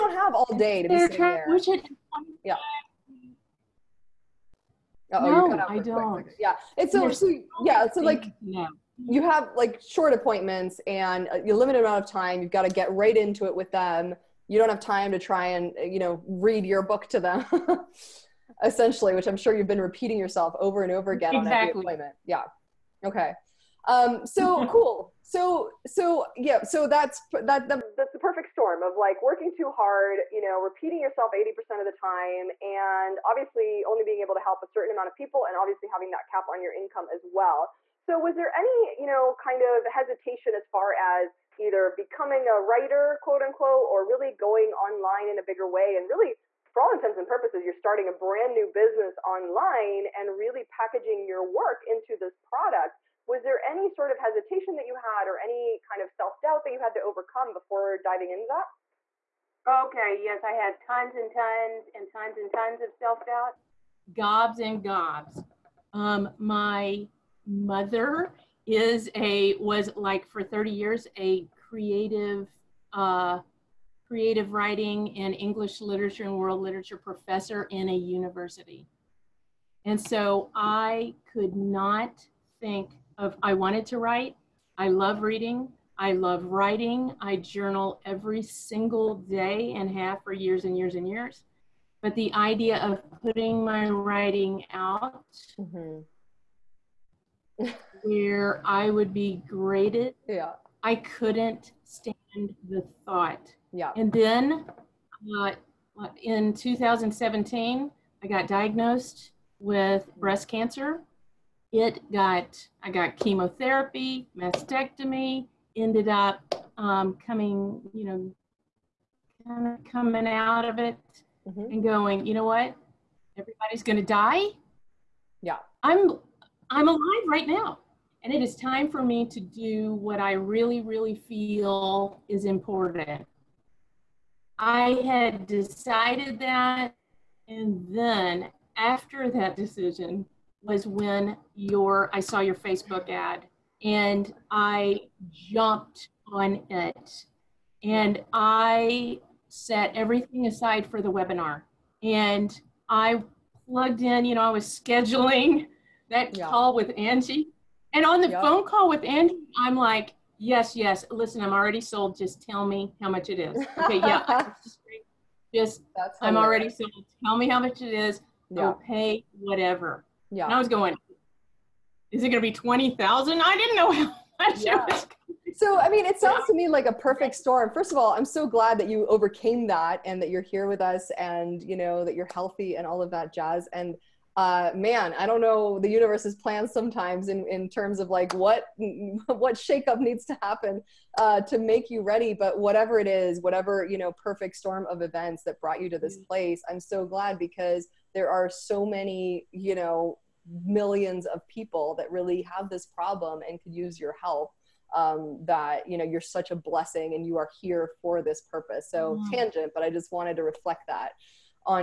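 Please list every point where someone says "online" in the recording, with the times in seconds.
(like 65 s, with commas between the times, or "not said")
44 s, 49 s.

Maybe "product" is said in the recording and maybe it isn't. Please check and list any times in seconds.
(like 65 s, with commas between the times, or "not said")
52 s.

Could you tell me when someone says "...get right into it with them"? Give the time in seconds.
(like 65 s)
12 s.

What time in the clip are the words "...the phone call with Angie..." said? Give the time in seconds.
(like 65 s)
158 s.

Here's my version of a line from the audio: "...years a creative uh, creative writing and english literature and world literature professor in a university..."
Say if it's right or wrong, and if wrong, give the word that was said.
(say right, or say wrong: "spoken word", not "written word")
right.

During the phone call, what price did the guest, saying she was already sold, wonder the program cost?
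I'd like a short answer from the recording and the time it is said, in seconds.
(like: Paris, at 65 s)
20,000, at 172 s.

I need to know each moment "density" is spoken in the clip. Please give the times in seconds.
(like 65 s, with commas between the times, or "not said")
not said.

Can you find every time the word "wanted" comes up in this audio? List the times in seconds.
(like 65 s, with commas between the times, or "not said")
83 s, 210 s.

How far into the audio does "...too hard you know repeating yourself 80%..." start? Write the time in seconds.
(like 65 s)
29 s.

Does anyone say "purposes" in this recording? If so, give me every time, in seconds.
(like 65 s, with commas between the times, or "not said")
47 s, 208 s.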